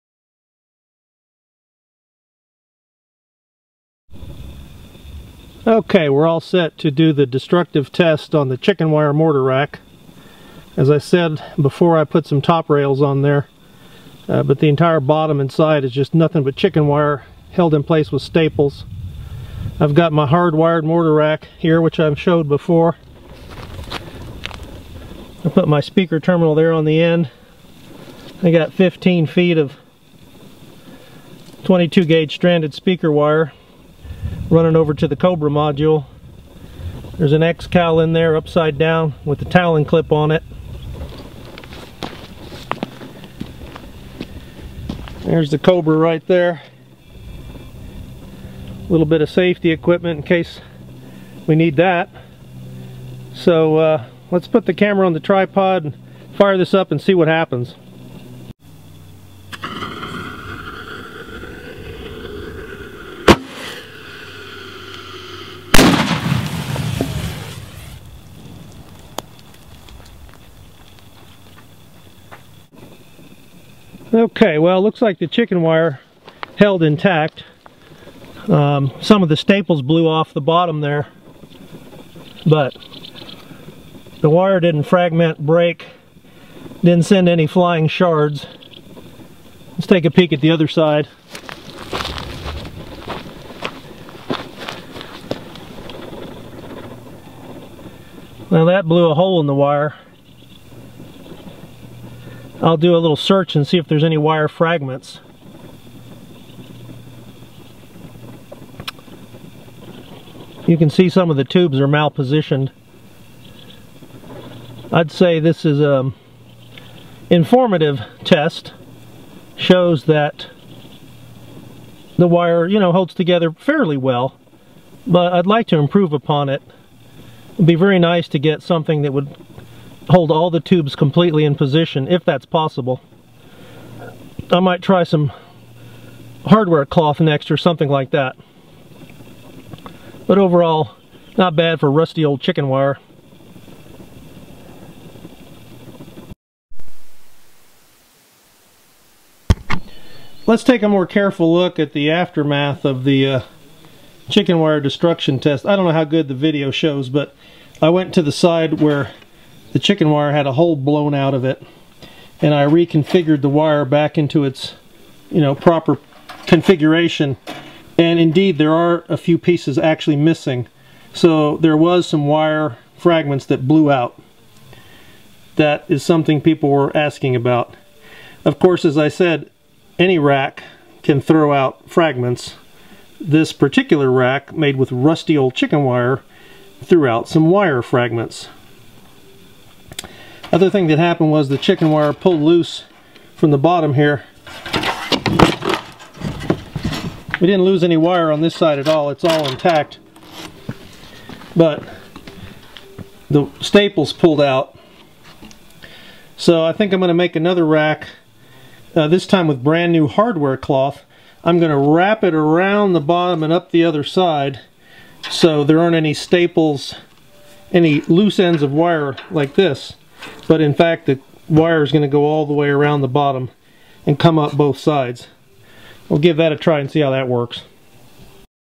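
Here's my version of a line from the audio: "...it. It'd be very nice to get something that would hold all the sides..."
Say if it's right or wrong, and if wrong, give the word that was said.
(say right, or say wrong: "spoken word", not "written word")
wrong: "tubes", not "sides".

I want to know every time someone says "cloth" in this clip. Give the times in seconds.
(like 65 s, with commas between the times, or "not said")
136 s, 210 s.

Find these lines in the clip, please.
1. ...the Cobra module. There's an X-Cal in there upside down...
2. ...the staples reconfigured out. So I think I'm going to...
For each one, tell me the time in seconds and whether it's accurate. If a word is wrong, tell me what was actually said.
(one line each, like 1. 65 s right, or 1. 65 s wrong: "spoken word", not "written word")
1. 35 s right
2. 203 s wrong: "pulled", not "reconfigured".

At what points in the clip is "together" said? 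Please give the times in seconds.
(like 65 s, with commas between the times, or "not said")
123 s.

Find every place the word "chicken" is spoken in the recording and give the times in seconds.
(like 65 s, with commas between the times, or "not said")
8 s, 16 s, 75 s, 142 s, 154 s, 159 s, 185 s, 191 s.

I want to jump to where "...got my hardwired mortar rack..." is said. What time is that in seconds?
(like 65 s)
19 s.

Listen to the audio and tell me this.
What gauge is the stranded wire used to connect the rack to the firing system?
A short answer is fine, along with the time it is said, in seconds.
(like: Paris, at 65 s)
22 gauge, at 31 s.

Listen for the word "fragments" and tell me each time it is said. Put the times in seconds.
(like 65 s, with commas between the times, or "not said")
84 s, 104 s, 172 s, 181 s, 187 s.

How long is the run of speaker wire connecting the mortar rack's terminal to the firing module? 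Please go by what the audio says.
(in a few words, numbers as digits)
15 feet.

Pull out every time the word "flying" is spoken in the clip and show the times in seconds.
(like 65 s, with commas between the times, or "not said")
87 s.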